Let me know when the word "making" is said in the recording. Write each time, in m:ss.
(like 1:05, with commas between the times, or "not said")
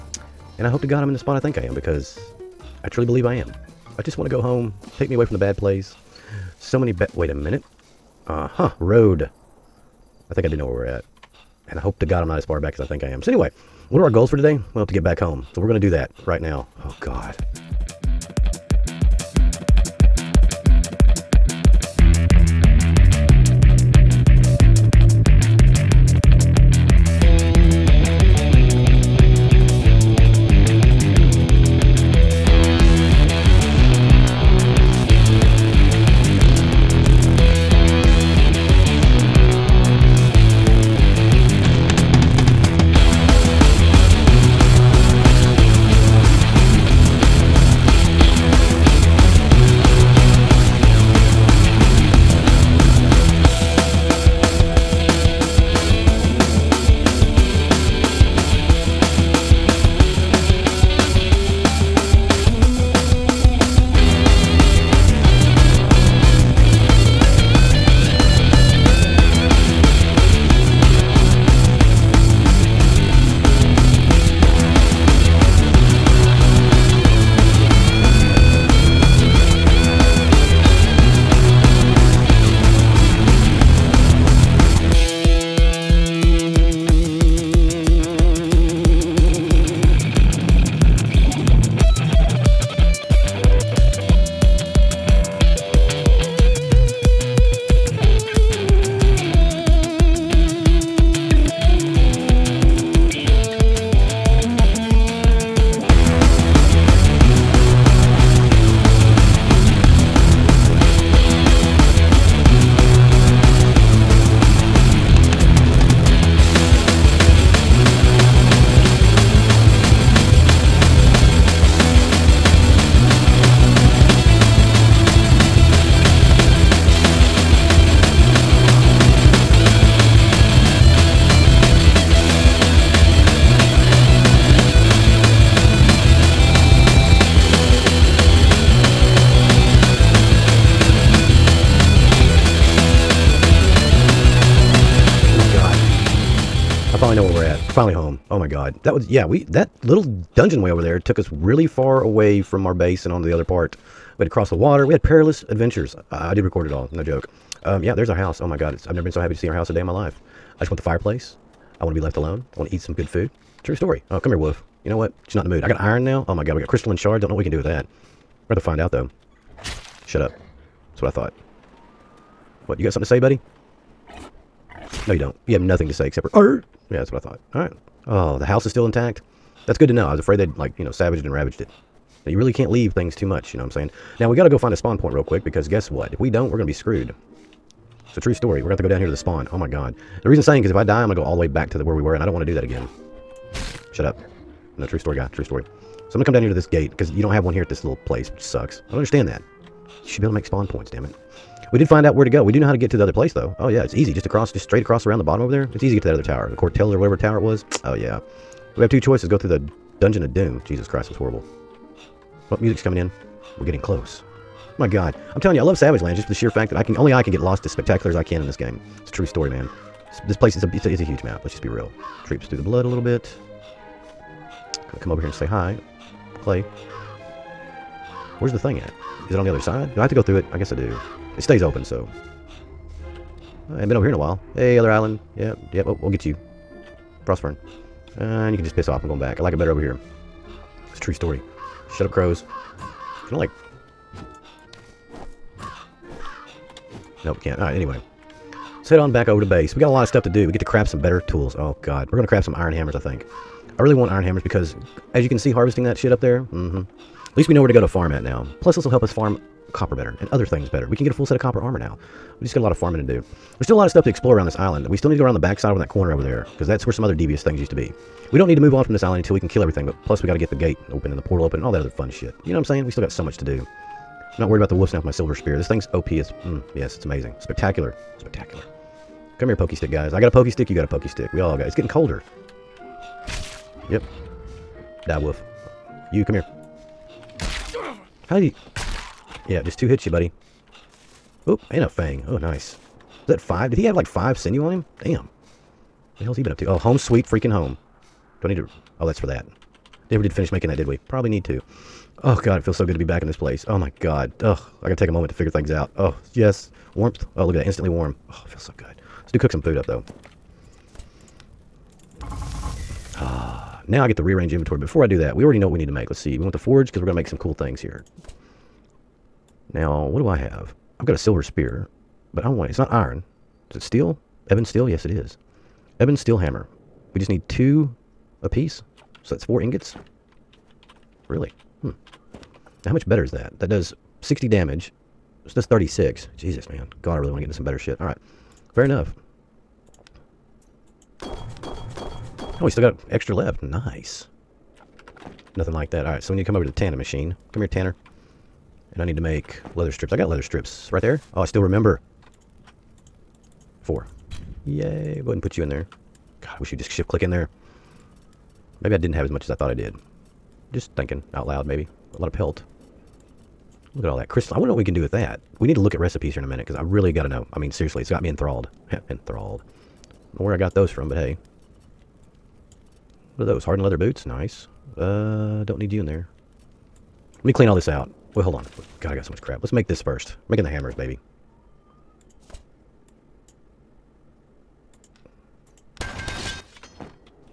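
5:00, 6:20.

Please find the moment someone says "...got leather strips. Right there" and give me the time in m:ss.
5:50.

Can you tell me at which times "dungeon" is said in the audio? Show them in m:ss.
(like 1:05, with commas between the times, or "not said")
2:30, 3:29.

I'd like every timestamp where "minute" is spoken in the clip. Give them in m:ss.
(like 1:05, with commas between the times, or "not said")
0:07, 6:06.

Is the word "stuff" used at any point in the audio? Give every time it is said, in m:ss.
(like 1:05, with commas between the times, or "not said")
4:10, 4:23.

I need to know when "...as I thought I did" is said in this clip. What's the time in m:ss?
5:59.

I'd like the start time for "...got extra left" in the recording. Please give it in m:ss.
5:42.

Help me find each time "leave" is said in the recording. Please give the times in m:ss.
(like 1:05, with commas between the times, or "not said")
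3:02.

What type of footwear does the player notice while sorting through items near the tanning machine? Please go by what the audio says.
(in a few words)
Hardened leather boots.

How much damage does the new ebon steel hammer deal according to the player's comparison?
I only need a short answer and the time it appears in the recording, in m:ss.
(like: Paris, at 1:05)
60, at 5:34.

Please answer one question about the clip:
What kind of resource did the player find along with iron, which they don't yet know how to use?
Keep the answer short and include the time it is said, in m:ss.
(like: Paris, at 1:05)
Crystalline shards, at 2:46.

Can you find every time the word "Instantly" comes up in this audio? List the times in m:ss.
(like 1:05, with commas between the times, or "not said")
5:07.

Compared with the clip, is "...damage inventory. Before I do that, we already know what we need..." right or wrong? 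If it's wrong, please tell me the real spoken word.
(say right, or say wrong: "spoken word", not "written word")
wrong: "rearrange", not "damage".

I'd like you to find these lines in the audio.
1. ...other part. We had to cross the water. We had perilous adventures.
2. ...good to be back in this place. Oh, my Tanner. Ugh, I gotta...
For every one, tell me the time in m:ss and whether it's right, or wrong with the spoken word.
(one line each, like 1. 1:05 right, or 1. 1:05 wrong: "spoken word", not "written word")
1. 2:33 right
2. 5:02 wrong: "God", not "Tanner".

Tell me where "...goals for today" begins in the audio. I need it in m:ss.
0:14.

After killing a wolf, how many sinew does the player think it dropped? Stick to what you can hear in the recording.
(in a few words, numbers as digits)
5.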